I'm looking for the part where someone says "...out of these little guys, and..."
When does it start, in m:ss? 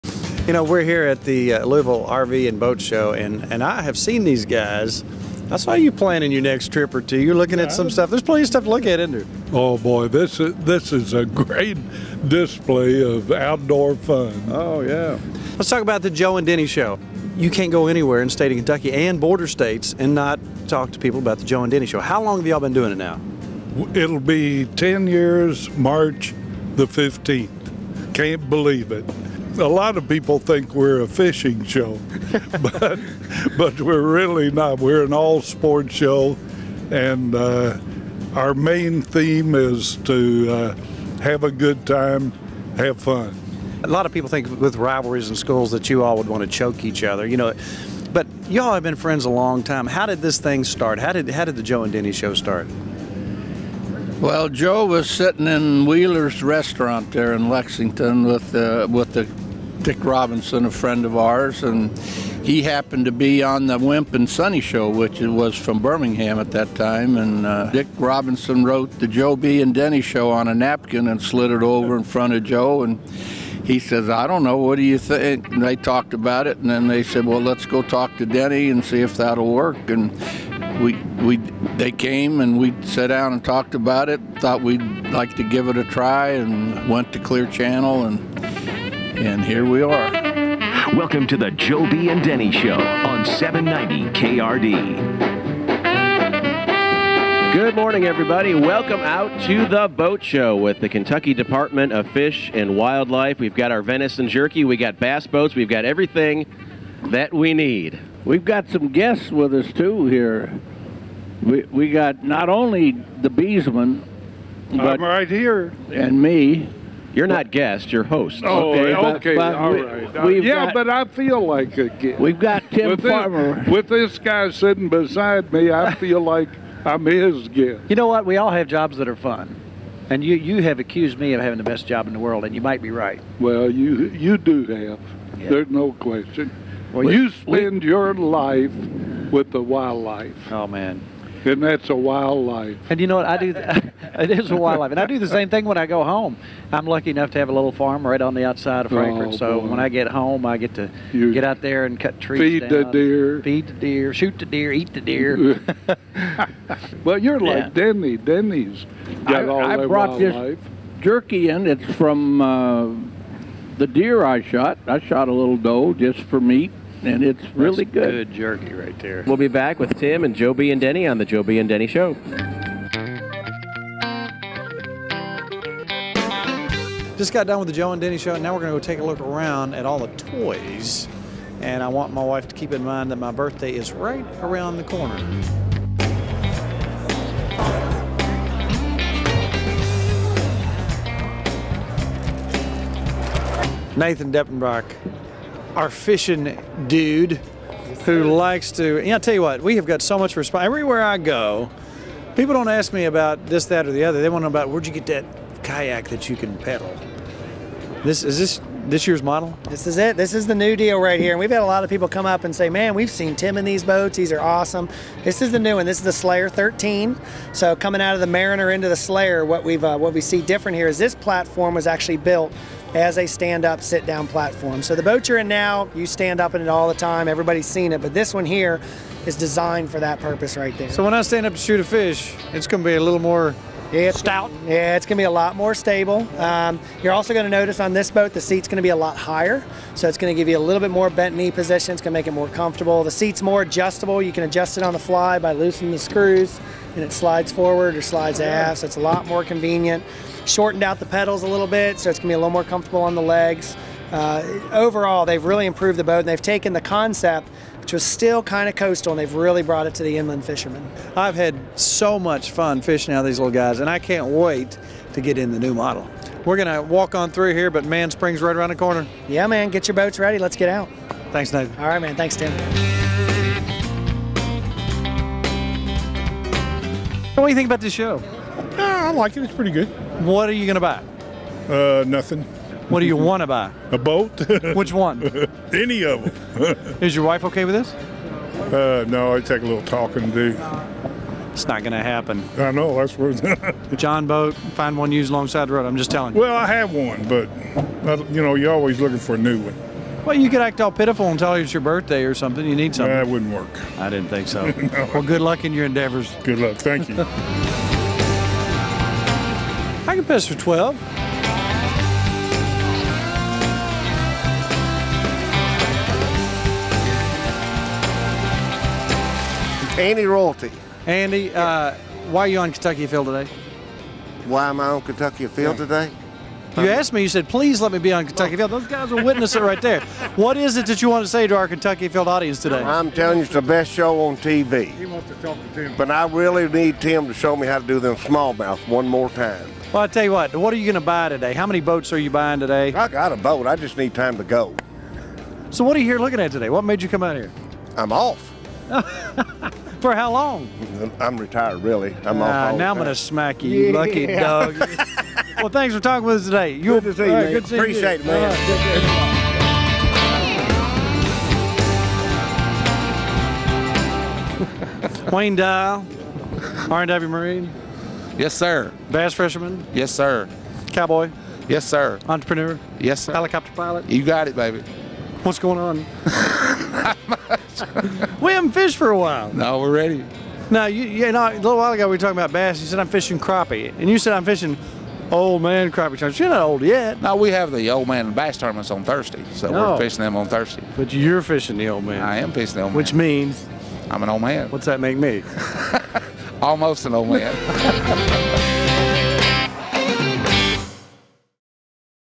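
4:23.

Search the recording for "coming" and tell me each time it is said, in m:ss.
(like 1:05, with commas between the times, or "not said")
3:37.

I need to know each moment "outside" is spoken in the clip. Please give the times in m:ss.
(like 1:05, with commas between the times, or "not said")
2:28.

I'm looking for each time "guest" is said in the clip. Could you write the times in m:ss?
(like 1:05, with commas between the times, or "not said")
1:48, 1:57, 2:01, 2:07.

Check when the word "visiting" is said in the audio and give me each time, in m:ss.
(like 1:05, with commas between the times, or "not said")
not said.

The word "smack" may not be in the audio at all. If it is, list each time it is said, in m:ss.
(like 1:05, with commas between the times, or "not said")
5:53.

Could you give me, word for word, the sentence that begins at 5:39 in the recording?
Well, I tell you what, what are you going to buy today?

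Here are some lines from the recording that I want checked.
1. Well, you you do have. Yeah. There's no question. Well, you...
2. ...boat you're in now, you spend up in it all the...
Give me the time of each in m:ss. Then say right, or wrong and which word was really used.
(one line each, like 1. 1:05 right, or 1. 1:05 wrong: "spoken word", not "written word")
1. 2:13 right
2. 3:45 wrong: "stand", not "spend".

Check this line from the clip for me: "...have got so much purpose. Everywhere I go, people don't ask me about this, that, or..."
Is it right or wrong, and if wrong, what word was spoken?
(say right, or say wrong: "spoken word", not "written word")
wrong: "response", not "purpose".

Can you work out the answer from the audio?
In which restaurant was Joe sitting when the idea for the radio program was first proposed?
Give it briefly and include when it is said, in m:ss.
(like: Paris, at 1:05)
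Wheeler's, at 0:55.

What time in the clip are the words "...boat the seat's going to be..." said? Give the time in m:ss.
3:58.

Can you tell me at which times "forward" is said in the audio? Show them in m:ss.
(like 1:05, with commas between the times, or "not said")
4:07.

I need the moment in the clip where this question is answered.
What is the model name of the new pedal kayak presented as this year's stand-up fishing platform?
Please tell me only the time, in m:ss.
3:36.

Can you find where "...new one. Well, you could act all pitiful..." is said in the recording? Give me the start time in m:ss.
4:59.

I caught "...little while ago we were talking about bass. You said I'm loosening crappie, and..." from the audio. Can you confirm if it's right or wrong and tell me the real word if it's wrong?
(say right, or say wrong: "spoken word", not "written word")
wrong: "fishing", not "loosening".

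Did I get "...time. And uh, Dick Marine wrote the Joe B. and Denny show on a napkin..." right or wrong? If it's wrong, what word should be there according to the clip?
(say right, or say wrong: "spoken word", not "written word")
wrong: "Robinson", not "Marine".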